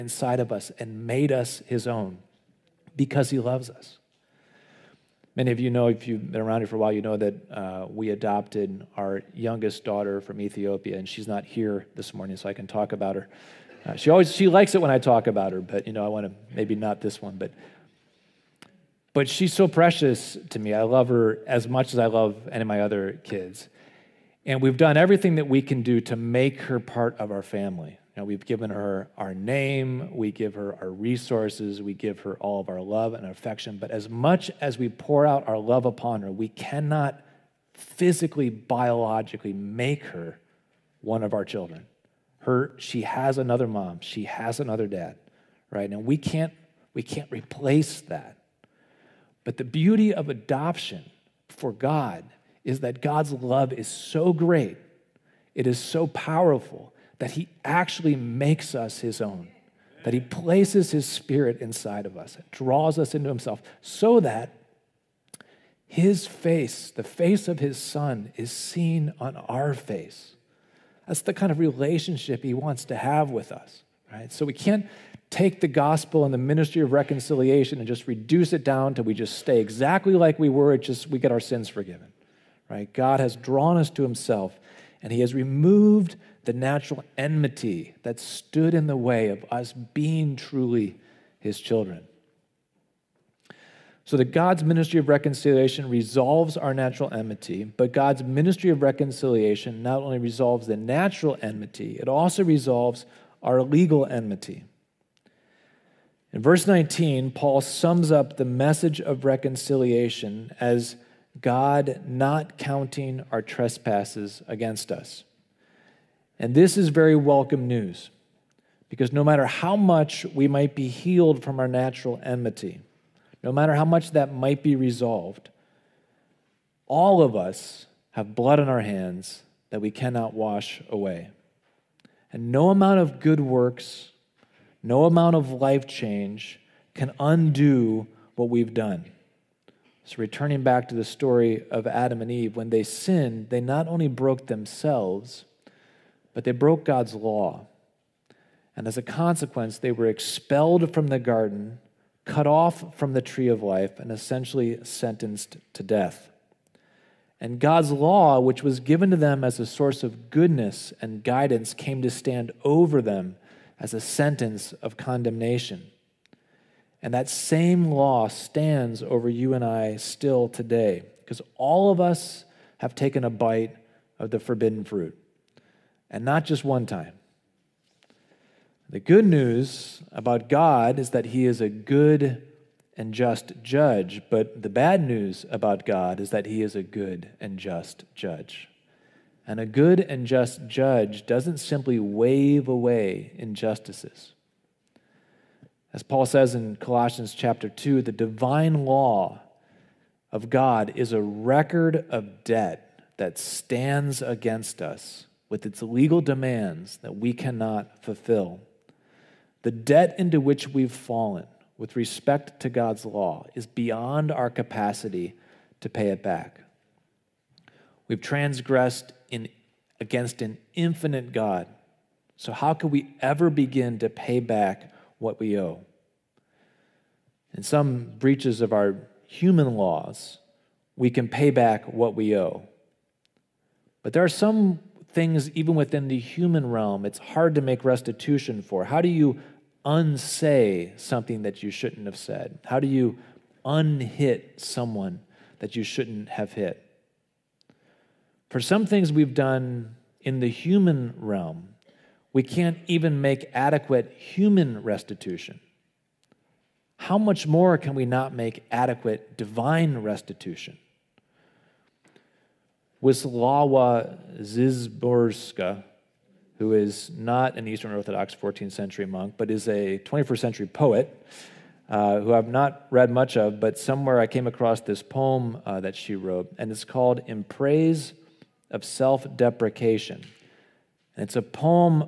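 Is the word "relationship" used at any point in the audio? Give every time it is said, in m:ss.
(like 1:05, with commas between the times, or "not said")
1:11.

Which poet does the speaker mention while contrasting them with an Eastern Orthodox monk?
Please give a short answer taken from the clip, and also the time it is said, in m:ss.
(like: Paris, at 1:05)
Wislawa Szymborska, at 4:23.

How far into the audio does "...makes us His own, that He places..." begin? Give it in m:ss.
0:58.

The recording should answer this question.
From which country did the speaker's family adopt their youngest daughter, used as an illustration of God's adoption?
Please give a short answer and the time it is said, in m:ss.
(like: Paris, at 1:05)
Ethiopia, at 0:10.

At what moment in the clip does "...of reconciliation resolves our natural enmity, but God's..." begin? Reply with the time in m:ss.
1:34.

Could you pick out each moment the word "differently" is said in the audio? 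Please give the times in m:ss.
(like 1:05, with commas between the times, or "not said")
not said.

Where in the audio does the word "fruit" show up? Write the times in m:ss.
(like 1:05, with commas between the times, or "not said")
2:54.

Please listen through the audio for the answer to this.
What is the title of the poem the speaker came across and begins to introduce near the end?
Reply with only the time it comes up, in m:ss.
4:37.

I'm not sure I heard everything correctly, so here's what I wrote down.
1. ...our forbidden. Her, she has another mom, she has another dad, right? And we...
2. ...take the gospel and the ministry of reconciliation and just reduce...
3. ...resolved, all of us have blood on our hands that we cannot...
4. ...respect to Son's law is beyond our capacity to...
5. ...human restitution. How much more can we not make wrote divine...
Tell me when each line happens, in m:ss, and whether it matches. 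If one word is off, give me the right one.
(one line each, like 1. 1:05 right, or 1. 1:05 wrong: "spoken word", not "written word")
1. 0:41 wrong: "children", not "forbidden"
2. 1:15 right
3. 2:04 right
4. 3:31 wrong: "God", not "Son"
5. 4:14 wrong: "adequate", not "wrote".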